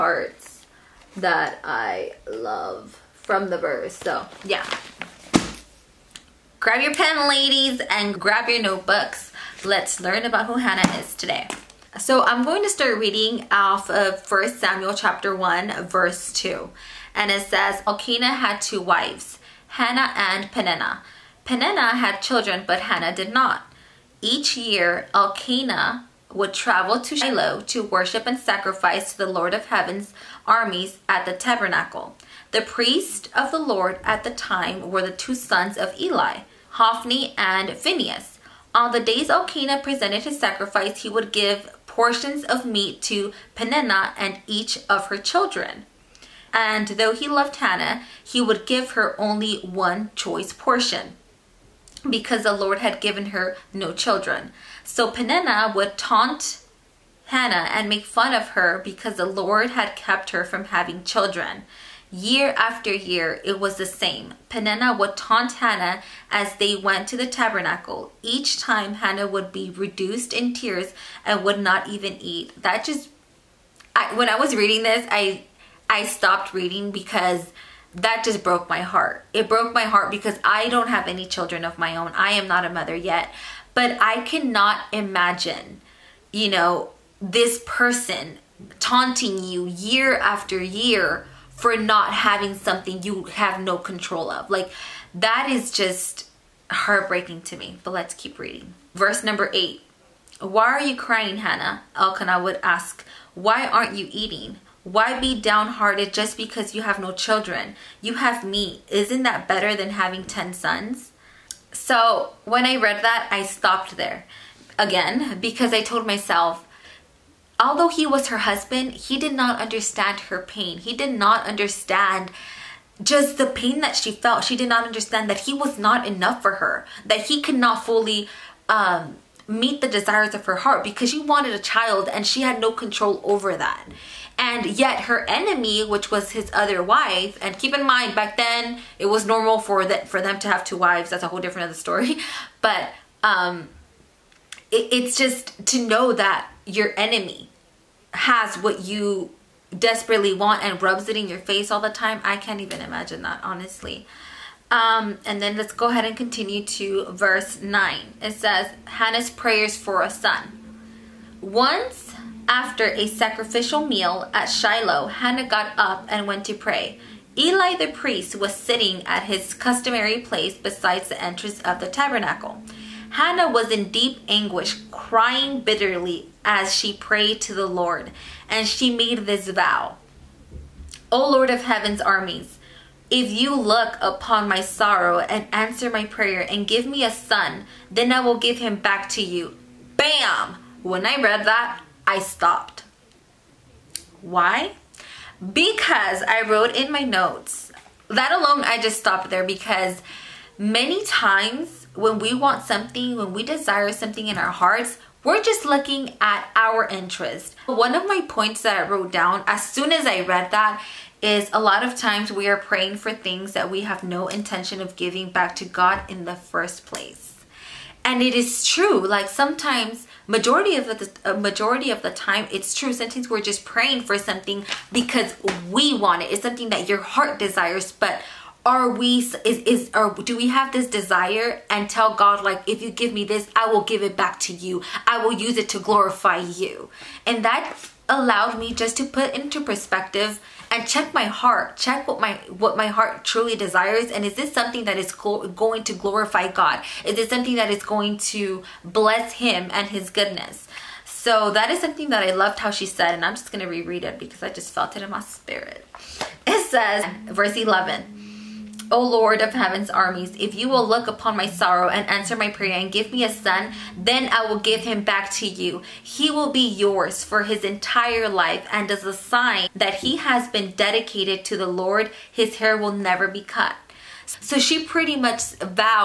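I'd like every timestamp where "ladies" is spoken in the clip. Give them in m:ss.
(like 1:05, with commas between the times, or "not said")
0:07.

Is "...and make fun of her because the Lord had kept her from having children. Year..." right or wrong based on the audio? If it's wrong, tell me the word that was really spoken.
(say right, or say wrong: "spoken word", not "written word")
right.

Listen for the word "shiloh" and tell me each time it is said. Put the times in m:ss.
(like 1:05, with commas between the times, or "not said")
0:27, 2:44.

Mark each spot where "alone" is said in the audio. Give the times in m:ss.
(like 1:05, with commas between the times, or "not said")
3:18.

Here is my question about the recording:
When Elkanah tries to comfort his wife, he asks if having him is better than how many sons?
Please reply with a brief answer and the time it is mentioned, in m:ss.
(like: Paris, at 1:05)
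10, at 1:50.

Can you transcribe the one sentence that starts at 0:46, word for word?
And though he loved Hannah, he would give her only one choice portion because the Lord had given her no children.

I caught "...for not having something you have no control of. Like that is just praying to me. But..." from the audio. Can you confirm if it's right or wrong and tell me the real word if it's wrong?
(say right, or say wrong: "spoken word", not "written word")
wrong: "heartbreaking", not "praying".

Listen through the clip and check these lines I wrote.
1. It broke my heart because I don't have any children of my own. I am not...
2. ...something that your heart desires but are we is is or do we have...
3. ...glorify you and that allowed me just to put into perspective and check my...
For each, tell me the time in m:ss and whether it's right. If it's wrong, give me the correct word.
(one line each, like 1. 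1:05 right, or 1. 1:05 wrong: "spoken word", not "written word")
1. 1:19 right
2. 3:46 right
3. 3:55 right.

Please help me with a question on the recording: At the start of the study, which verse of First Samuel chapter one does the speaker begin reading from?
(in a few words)
2.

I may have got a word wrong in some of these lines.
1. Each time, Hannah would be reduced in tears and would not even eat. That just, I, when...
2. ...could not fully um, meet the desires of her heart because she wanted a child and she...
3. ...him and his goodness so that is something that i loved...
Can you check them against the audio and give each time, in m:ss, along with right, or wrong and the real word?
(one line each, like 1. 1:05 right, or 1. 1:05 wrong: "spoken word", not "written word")
1. 1:08 right
2. 2:07 right
3. 4:09 right.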